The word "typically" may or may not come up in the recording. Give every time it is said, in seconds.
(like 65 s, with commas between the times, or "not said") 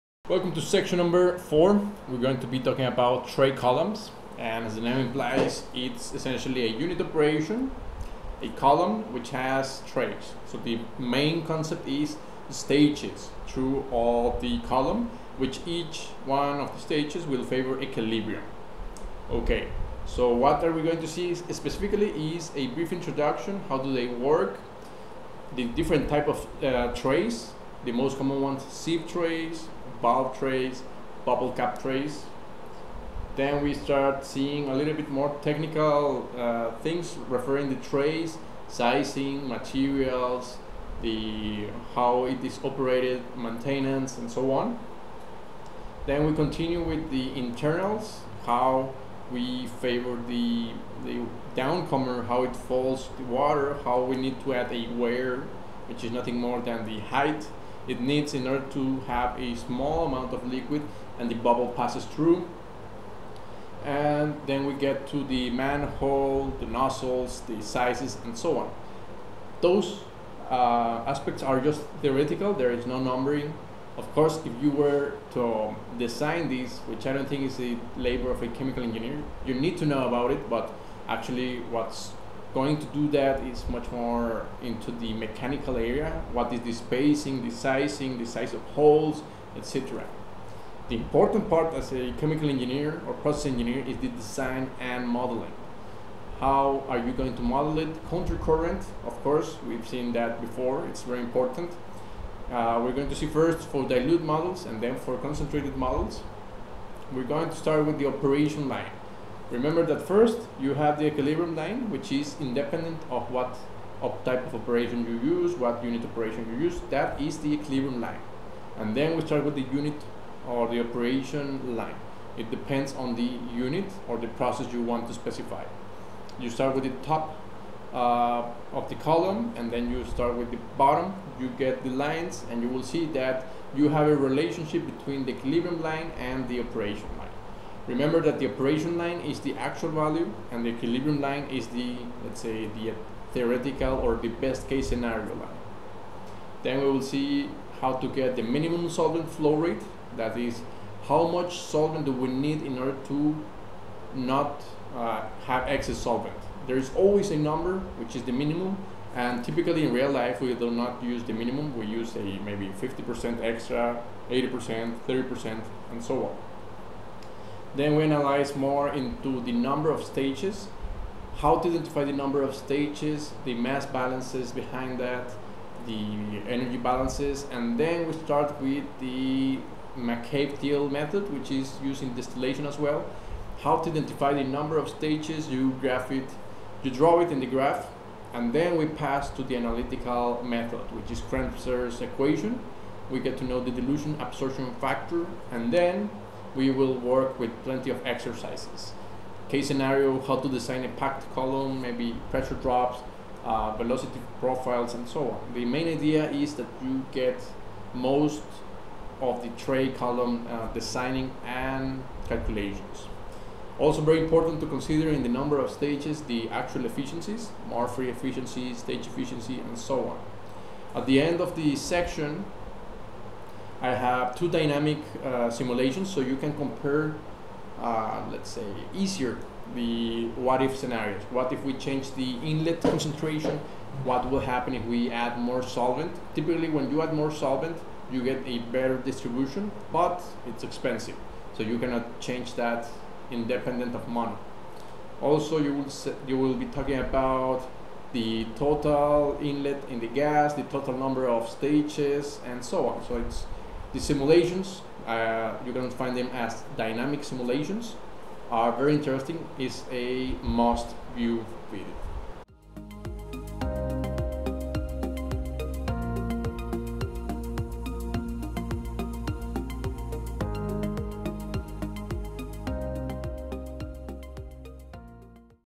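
159 s, 236 s.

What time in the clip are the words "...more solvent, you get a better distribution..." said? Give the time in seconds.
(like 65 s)
237 s.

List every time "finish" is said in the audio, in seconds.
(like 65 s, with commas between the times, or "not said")
not said.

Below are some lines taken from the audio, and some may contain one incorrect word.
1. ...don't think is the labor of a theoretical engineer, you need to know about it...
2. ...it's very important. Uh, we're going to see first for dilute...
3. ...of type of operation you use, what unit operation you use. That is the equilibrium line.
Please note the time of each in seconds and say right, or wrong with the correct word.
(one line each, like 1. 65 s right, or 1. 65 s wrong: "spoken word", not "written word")
1. 77 s wrong: "chemical", not "theoretical"
2. 100 s right
3. 114 s right.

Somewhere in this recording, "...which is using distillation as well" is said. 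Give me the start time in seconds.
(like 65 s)
181 s.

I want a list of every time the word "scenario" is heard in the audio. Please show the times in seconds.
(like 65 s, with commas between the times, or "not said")
144 s, 199 s, 230 s.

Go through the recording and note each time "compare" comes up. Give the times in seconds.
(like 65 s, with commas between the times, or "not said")
226 s.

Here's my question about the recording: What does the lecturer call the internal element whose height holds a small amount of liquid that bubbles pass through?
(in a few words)
Weir.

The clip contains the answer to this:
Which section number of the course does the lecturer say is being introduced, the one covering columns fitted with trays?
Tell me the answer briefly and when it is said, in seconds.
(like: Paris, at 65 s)
4, at 1 s.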